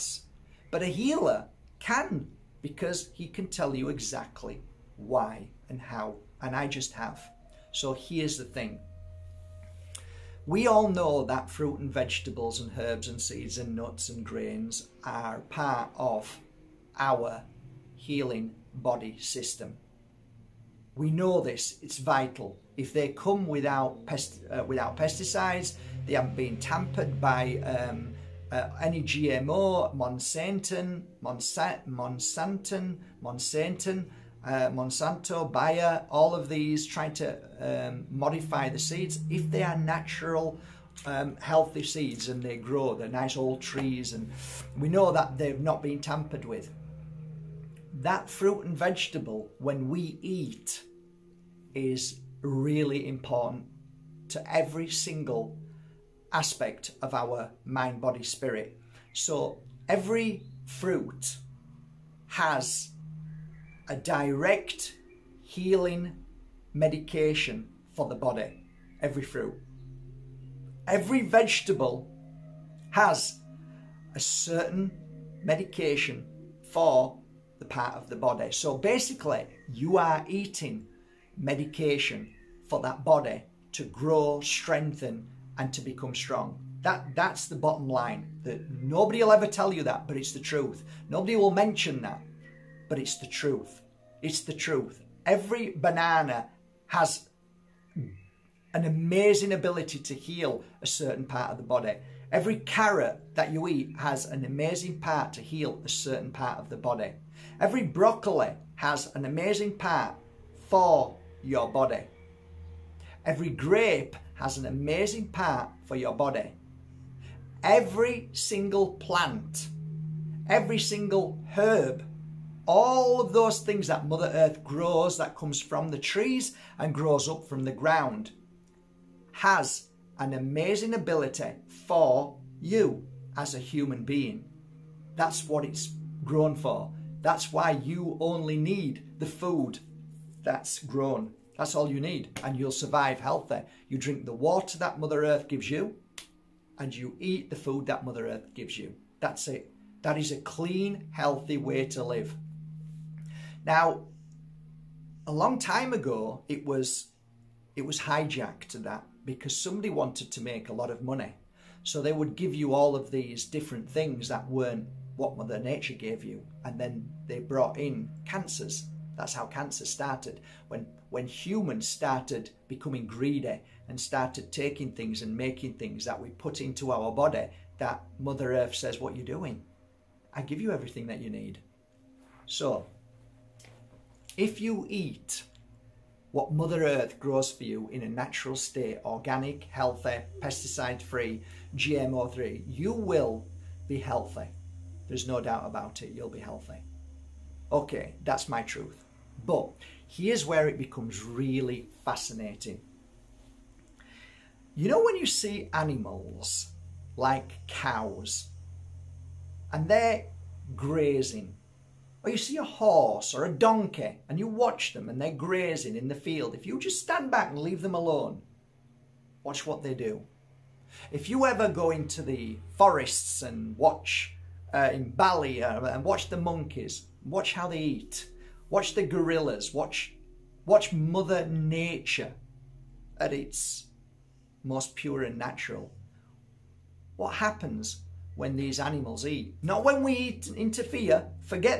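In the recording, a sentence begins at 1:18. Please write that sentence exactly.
So basically, you are eating medication for that body to grow, strengthen, and to become strong.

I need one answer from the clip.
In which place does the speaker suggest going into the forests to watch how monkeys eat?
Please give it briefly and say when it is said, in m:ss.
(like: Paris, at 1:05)
Bali, at 3:45.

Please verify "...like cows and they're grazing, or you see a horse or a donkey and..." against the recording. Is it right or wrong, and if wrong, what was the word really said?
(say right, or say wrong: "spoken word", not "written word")
right.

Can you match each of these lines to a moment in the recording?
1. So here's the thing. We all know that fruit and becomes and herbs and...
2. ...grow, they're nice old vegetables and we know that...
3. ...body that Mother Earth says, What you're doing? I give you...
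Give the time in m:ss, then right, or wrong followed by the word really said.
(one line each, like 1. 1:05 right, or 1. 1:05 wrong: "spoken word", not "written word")
1. 0:07 wrong: "vegetables", not "becomes"
2. 0:42 wrong: "trees", not "vegetables"
3. 2:57 right.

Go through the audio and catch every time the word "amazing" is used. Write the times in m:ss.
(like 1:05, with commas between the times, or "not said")
1:38, 1:44, 1:49, 1:54, 2:10.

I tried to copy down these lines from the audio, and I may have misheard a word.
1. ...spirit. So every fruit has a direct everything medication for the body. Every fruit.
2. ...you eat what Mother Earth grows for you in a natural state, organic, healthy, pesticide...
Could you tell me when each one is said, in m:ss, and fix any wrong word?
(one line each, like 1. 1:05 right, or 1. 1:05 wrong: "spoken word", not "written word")
1. 0:58 wrong: "healing", not "everything"
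2. 3:04 right.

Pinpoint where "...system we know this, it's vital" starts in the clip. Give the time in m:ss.
0:19.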